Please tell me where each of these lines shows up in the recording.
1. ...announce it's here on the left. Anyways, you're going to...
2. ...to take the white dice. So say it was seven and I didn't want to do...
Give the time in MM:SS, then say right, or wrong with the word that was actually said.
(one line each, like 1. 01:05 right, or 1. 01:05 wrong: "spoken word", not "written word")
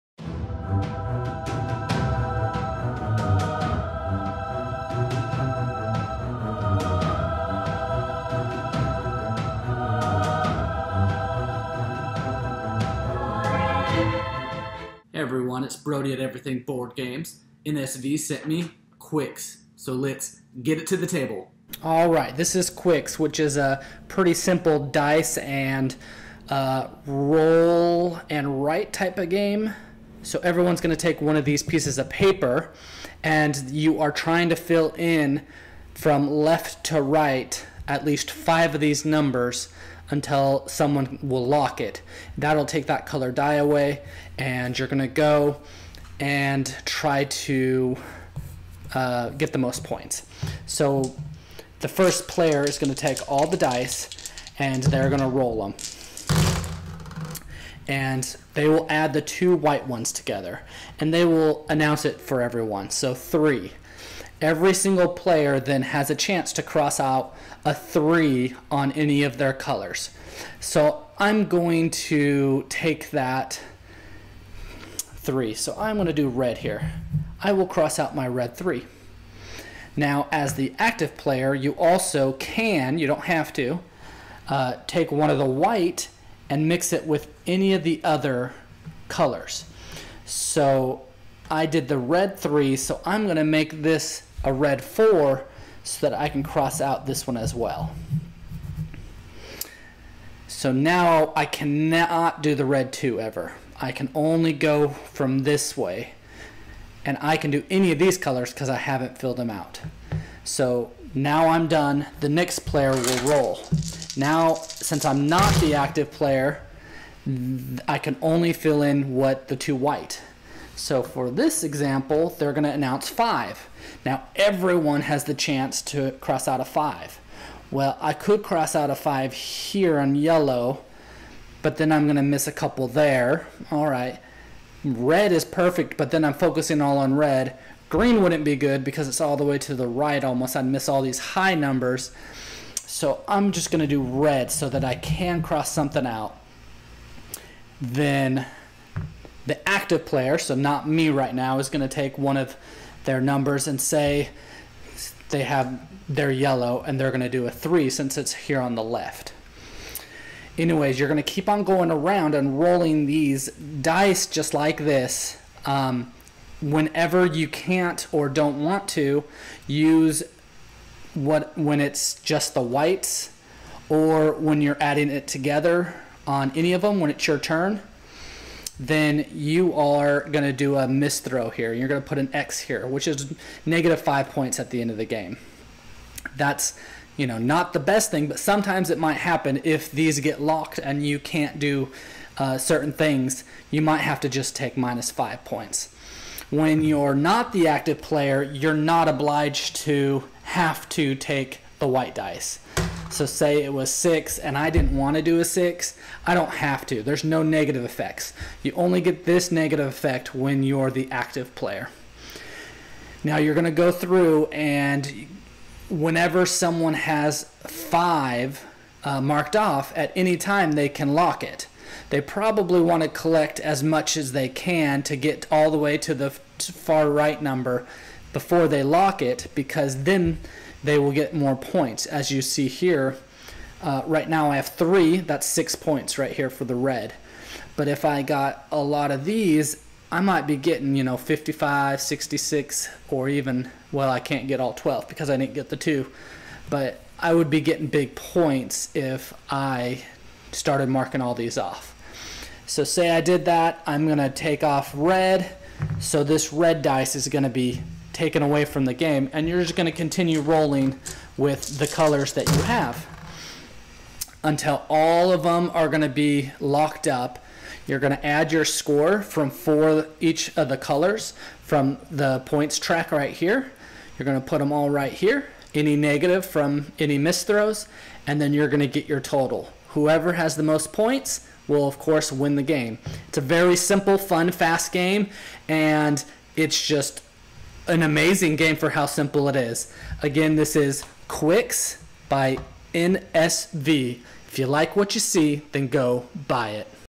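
1. 02:37 wrong: "since", not "announce"
2. 03:20 wrong: "six", not "seven".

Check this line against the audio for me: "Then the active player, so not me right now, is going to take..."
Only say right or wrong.
right.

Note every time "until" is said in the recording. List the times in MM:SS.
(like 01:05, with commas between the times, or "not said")
00:40, 04:24.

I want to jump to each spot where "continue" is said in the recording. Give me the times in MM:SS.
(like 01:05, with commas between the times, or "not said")
04:19.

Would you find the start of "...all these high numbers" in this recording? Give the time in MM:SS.
02:20.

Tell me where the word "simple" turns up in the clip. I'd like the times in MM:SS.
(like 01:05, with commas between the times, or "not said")
00:24, 04:43, 04:49.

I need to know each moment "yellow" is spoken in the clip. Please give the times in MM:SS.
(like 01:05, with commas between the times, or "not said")
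02:10, 02:36.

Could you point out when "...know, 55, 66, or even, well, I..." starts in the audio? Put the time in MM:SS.
04:01.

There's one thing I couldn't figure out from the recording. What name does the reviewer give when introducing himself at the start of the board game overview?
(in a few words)
Brody.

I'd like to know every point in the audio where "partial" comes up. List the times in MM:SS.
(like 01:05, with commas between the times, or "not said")
not said.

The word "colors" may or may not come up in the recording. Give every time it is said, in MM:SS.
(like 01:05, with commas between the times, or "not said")
00:43, 01:09, 01:29, 01:48, 04:21, 04:30.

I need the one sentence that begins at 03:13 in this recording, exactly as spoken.
You might have to just take minus five points.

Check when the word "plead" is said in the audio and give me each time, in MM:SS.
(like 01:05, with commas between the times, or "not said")
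not said.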